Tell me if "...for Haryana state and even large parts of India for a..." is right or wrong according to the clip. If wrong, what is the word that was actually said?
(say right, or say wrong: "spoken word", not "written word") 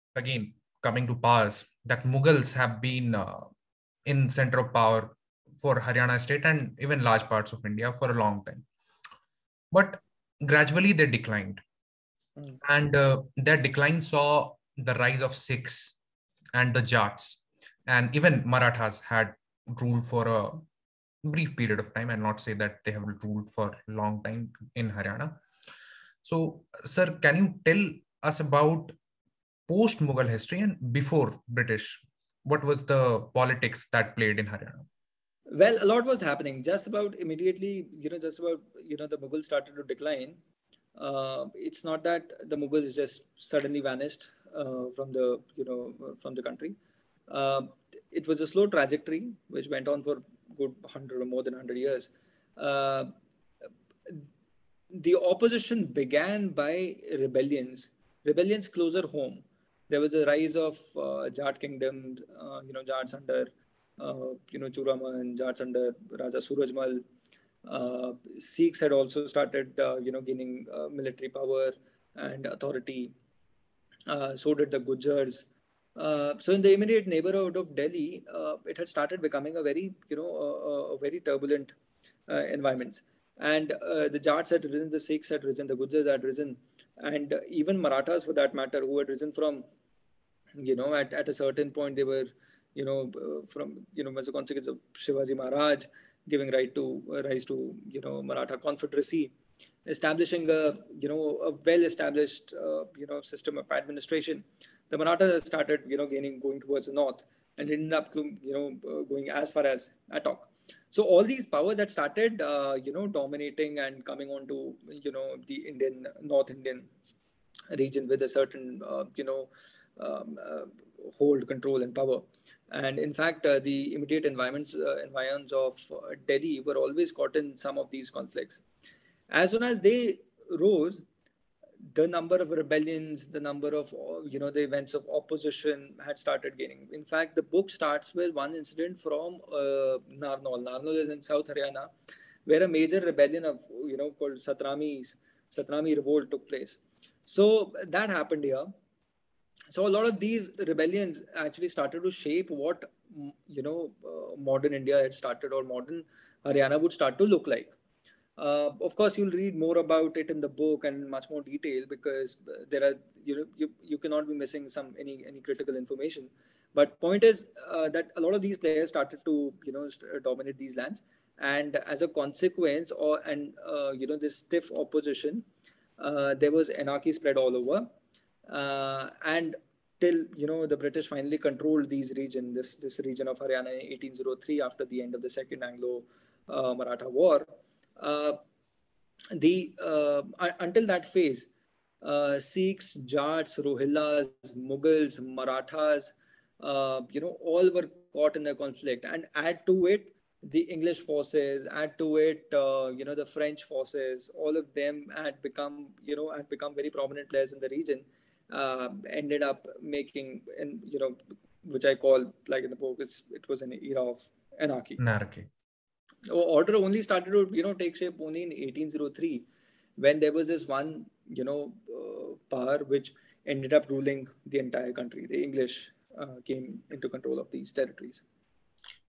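right.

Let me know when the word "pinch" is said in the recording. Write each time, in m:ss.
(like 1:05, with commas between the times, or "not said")
not said.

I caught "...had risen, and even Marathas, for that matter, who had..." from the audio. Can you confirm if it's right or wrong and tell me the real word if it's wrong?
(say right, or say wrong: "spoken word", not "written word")
right.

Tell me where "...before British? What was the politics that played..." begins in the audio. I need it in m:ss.
0:30.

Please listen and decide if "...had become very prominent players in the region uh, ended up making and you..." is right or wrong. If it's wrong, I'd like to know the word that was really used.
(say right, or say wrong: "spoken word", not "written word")
right.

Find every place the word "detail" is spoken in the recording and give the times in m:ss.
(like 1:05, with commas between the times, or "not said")
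2:41.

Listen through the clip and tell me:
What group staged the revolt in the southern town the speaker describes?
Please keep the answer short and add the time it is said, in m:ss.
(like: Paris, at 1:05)
Satnamis, at 2:24.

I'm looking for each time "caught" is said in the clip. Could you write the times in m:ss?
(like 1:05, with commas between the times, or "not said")
2:07, 3:18.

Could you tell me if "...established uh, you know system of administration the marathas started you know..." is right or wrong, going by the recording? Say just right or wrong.
right.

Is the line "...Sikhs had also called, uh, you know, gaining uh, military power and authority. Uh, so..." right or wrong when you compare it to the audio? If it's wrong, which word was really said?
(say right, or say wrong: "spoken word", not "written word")
wrong: "started", not "called".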